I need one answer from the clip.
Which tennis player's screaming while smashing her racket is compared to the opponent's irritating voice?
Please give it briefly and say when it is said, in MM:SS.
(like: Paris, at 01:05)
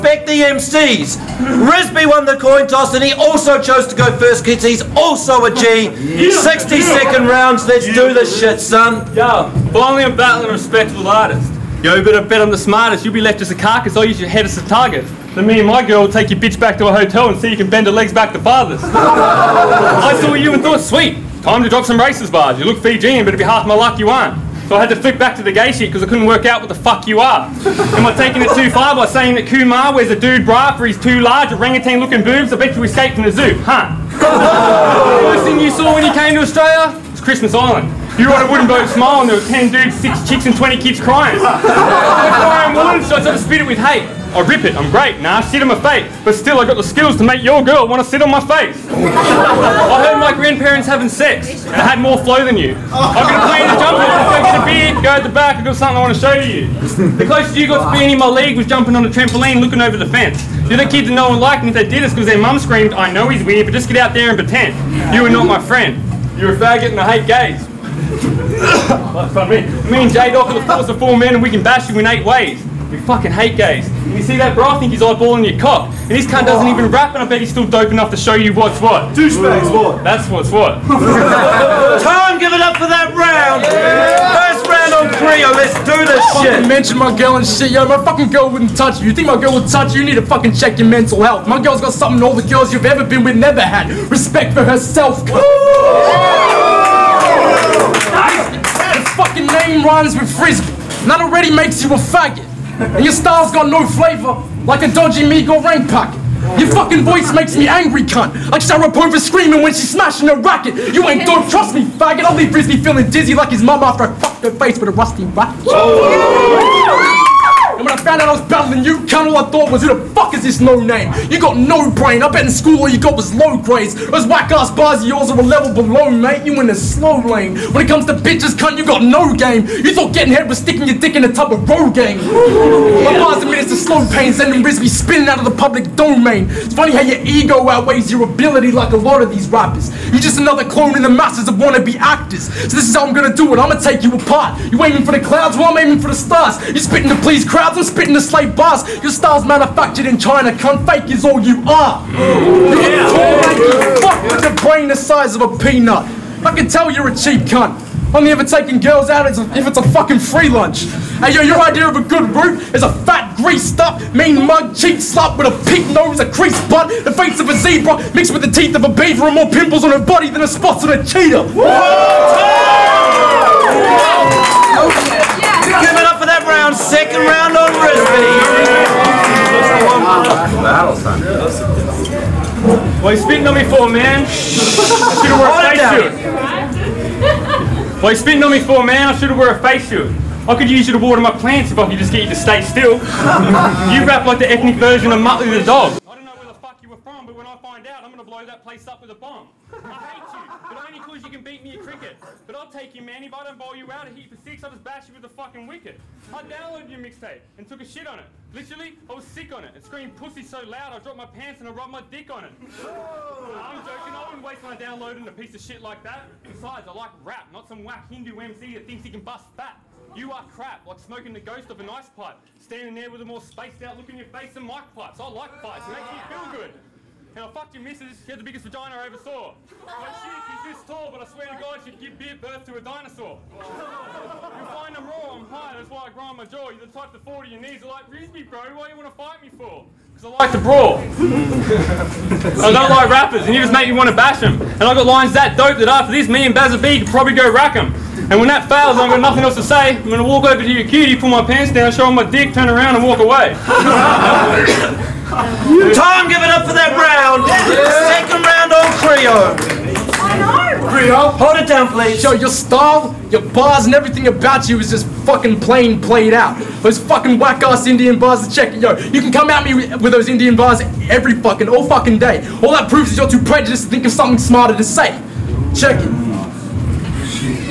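Sharapova, at 01:48.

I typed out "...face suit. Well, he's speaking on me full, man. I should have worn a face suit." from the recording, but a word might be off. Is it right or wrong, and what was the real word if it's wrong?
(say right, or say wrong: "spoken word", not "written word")
right.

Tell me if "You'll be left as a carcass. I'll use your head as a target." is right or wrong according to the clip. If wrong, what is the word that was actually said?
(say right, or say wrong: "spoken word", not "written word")
right.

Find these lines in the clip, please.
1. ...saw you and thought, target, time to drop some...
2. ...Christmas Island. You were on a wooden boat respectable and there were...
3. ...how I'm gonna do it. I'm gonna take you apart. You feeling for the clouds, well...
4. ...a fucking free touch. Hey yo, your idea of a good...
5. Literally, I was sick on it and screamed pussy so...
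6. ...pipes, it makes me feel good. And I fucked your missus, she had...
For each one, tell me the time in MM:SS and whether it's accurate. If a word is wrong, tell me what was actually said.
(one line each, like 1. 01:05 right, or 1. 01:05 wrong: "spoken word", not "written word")
1. 00:20 wrong: "sweet", not "target"
2. 00:37 wrong: "smile", not "respectable"
3. 02:22 wrong: "aiming", not "feeling"
4. 02:39 wrong: "lunch", not "touch"
5. 03:28 right
6. 03:45 right.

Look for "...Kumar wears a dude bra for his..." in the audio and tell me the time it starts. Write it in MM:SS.
00:29.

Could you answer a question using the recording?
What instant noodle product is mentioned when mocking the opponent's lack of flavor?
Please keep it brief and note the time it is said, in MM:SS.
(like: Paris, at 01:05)
Mi Goreng, at 01:45.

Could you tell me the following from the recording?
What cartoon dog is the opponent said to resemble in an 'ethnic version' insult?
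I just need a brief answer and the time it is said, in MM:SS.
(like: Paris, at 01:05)
Muttley, at 03:15.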